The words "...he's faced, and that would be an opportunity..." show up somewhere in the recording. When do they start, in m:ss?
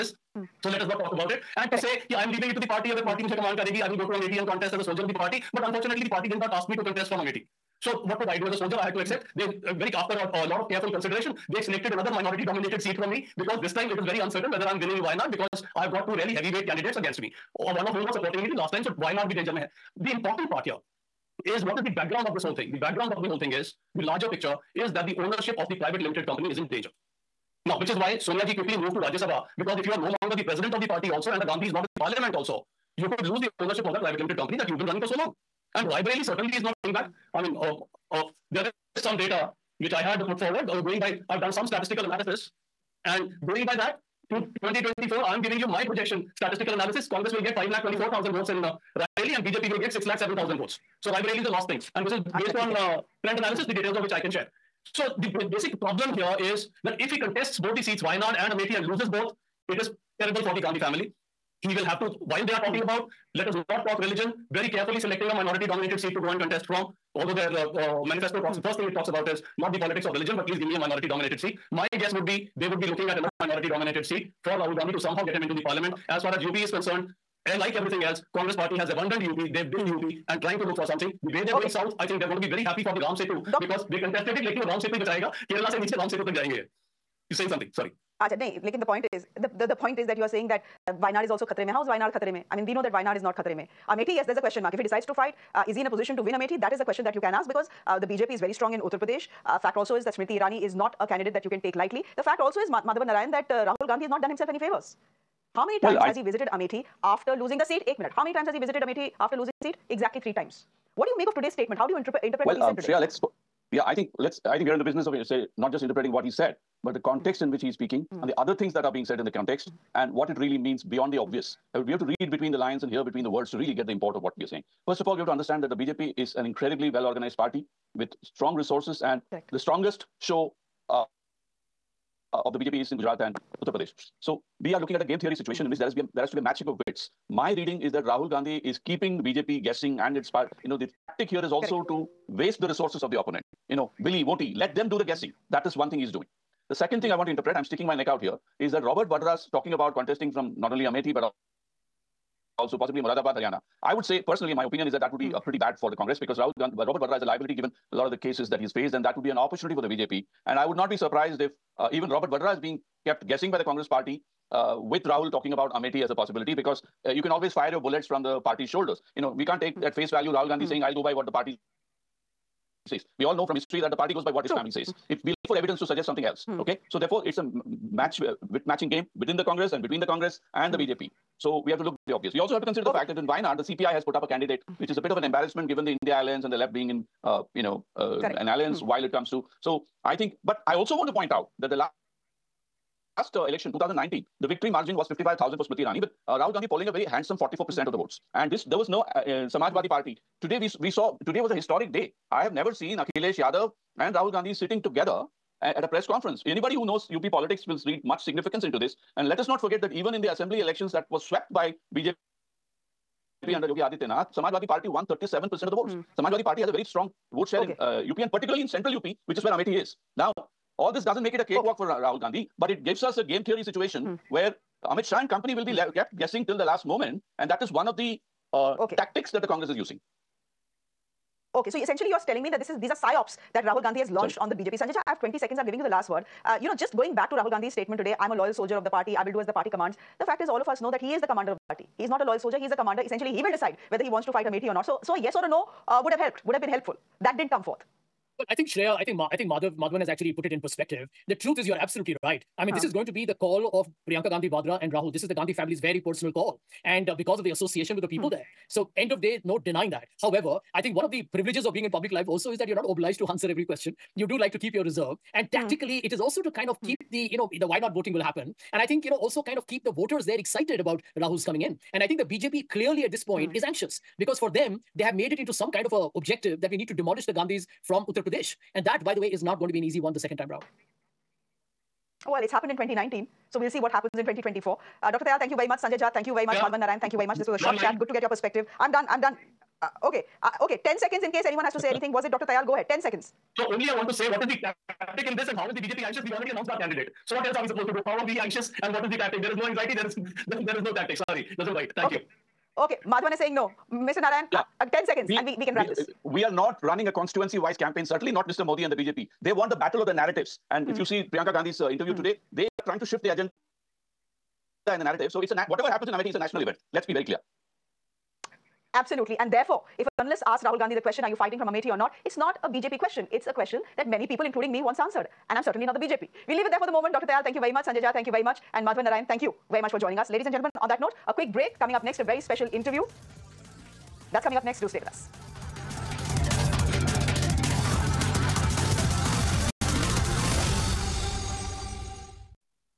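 2:38.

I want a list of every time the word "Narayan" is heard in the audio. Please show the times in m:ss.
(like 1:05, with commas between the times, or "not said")
1:43, 4:46, 5:04, 5:29.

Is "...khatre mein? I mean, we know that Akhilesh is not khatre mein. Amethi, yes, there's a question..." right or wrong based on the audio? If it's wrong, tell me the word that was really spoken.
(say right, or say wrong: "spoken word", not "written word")
wrong: "Wayanad", not "Akhilesh".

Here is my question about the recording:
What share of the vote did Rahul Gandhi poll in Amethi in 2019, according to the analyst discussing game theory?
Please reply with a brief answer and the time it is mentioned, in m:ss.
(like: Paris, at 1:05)
44%, at 3:17.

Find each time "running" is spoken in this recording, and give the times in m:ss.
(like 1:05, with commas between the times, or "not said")
0:34, 5:06.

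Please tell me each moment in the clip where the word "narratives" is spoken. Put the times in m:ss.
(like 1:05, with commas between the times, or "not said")
5:10, 5:15.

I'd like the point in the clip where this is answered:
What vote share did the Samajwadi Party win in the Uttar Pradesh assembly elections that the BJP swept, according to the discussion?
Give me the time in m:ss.
3:35.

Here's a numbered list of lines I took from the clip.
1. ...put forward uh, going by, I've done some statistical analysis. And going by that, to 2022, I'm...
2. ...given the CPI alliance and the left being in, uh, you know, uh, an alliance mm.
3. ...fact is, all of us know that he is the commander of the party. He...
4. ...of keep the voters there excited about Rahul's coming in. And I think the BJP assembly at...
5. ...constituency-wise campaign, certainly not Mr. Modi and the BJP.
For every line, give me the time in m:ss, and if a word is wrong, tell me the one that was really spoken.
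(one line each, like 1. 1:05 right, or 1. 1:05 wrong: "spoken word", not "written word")
1. 0:40 wrong: "2024", not "2022"
2. 3:05 wrong: "India", not "CPI"
3. 4:00 right
4. 4:29 wrong: "clearly", not "assembly"
5. 5:07 right.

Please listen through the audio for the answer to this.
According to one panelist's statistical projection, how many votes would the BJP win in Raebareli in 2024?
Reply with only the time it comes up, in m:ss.
0:49.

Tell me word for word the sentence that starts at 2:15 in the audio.
in which there has, be a, there has to be a matching of wits.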